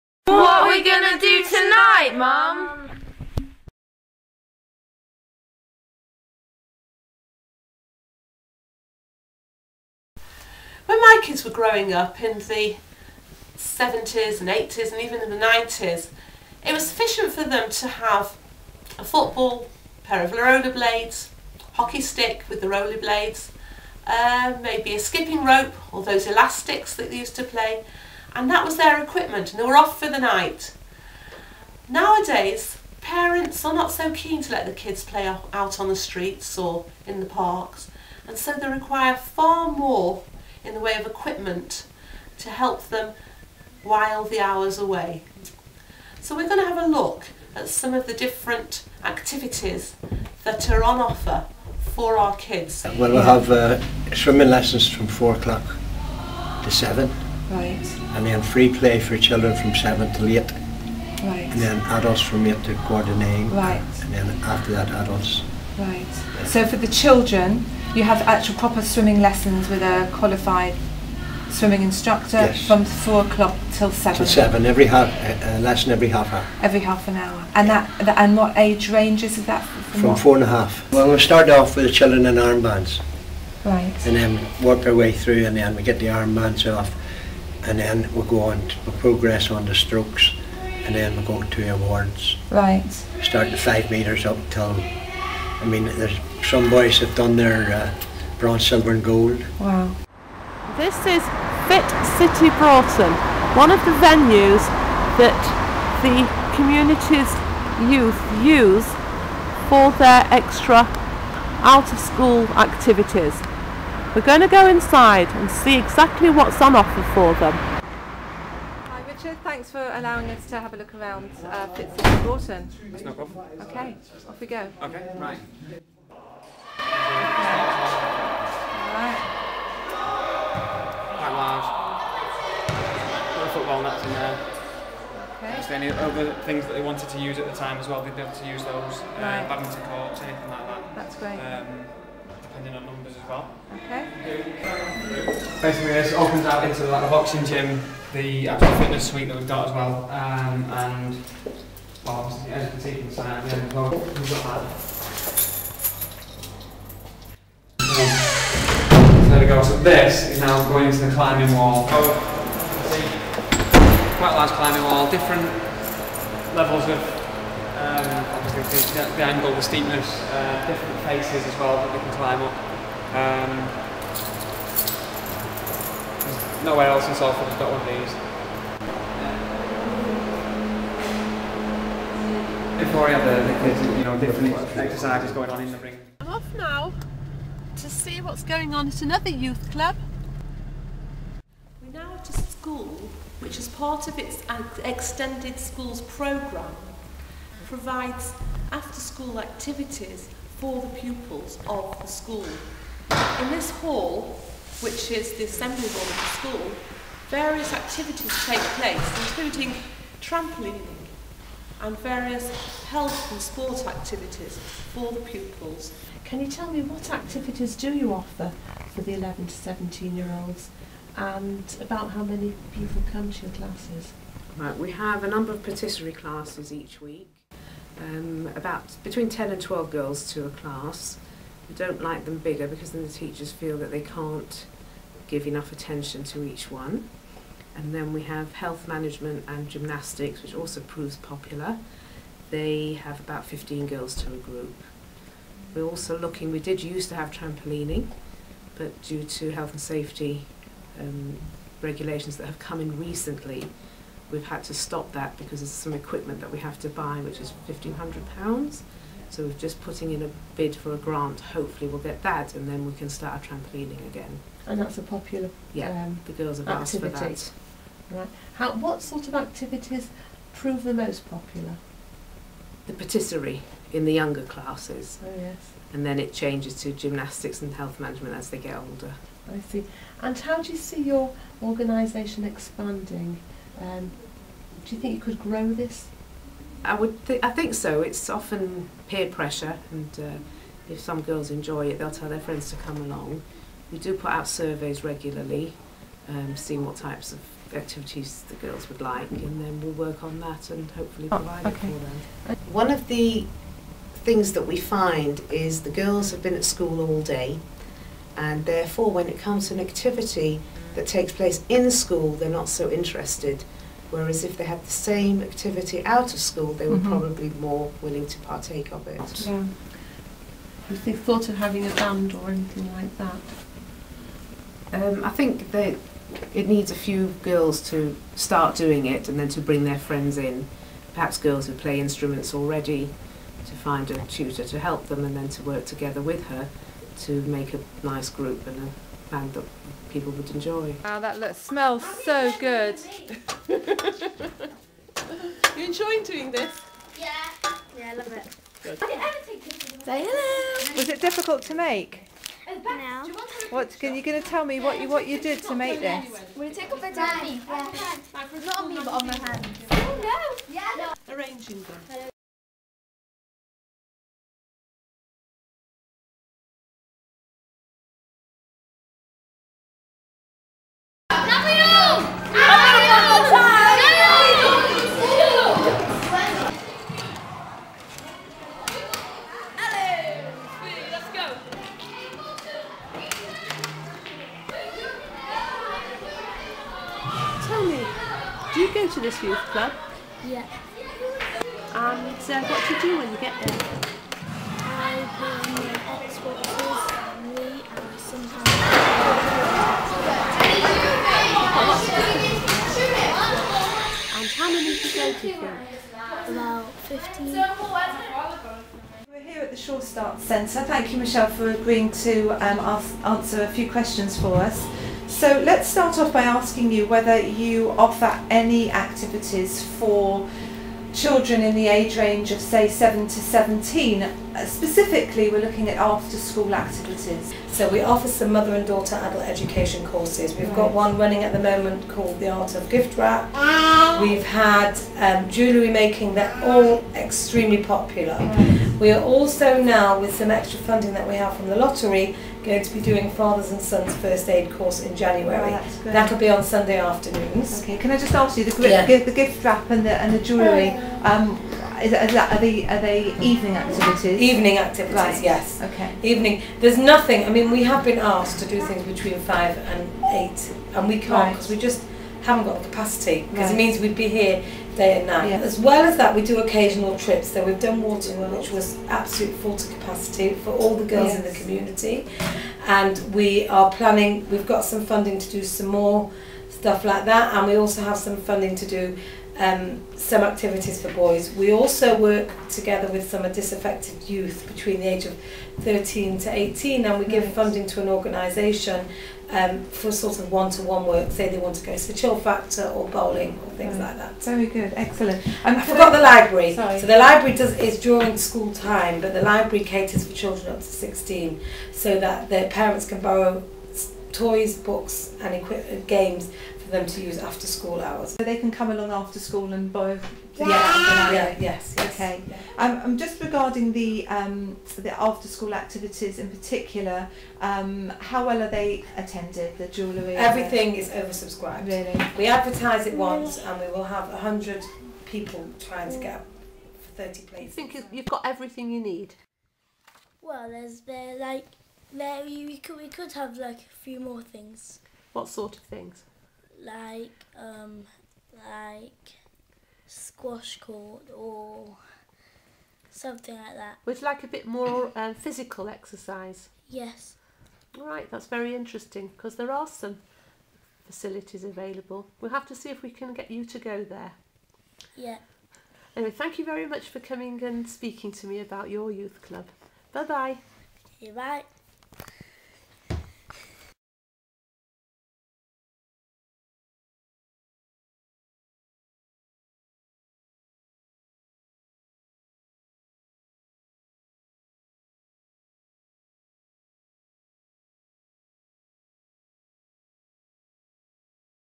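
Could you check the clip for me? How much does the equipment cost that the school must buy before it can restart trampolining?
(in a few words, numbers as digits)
£1,500.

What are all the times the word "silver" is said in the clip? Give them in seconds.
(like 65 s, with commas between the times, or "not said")
98 s.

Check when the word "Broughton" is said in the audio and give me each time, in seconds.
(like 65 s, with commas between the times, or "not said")
102 s, 122 s.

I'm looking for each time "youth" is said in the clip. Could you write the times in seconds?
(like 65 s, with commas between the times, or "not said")
107 s, 189 s, 389 s, 484 s, 559 s.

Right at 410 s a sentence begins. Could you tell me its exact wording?
Thank you, Michelle, for agreeing to um, ask, answer a few questions for us.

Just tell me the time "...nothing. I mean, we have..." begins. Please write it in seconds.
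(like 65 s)
456 s.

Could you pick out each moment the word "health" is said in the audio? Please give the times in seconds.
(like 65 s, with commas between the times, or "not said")
212 s, 238 s, 249 s, 277 s.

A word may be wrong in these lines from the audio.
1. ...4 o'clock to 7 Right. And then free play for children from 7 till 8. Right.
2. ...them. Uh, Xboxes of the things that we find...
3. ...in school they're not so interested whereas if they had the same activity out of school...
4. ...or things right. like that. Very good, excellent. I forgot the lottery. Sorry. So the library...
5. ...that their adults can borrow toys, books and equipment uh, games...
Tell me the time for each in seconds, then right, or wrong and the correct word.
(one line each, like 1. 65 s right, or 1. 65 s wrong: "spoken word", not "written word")
1. 55 s right
2. 302 s wrong: "One", not "Xboxes"
3. 311 s right
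4. 493 s wrong: "library", not "lottery"
5. 502 s wrong: "parents", not "adults".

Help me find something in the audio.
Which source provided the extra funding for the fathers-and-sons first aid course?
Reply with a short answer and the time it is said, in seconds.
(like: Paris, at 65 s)
the lottery, at 441 s.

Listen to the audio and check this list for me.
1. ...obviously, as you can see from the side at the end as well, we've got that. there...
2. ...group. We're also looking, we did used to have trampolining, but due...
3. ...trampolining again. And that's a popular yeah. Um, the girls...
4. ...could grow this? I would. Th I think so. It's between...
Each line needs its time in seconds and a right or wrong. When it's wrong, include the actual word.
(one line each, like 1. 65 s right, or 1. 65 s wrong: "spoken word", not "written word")
1. 152 s right
2. 244 s right
3. 263 s right
4. 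285 s wrong: "often", not "between".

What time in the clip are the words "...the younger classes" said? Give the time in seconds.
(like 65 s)
274 s.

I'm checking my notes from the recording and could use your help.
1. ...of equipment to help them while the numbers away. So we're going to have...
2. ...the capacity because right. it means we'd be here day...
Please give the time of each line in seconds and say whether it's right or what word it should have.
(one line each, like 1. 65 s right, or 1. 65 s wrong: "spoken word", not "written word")
1. 40 s wrong: "hours", not "numbers"
2. 462 s right.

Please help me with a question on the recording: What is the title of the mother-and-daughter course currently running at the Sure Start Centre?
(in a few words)
The Art of Gift Wrap.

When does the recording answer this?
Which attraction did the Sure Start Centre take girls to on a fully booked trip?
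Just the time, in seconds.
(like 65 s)
468 s.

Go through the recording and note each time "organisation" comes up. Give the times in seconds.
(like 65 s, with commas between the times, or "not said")
281 s, 488 s.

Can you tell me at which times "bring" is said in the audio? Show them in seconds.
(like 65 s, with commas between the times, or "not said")
329 s, 395 s.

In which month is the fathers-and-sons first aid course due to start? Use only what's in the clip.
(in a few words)
January.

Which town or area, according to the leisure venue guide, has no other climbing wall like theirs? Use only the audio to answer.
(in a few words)
Salford.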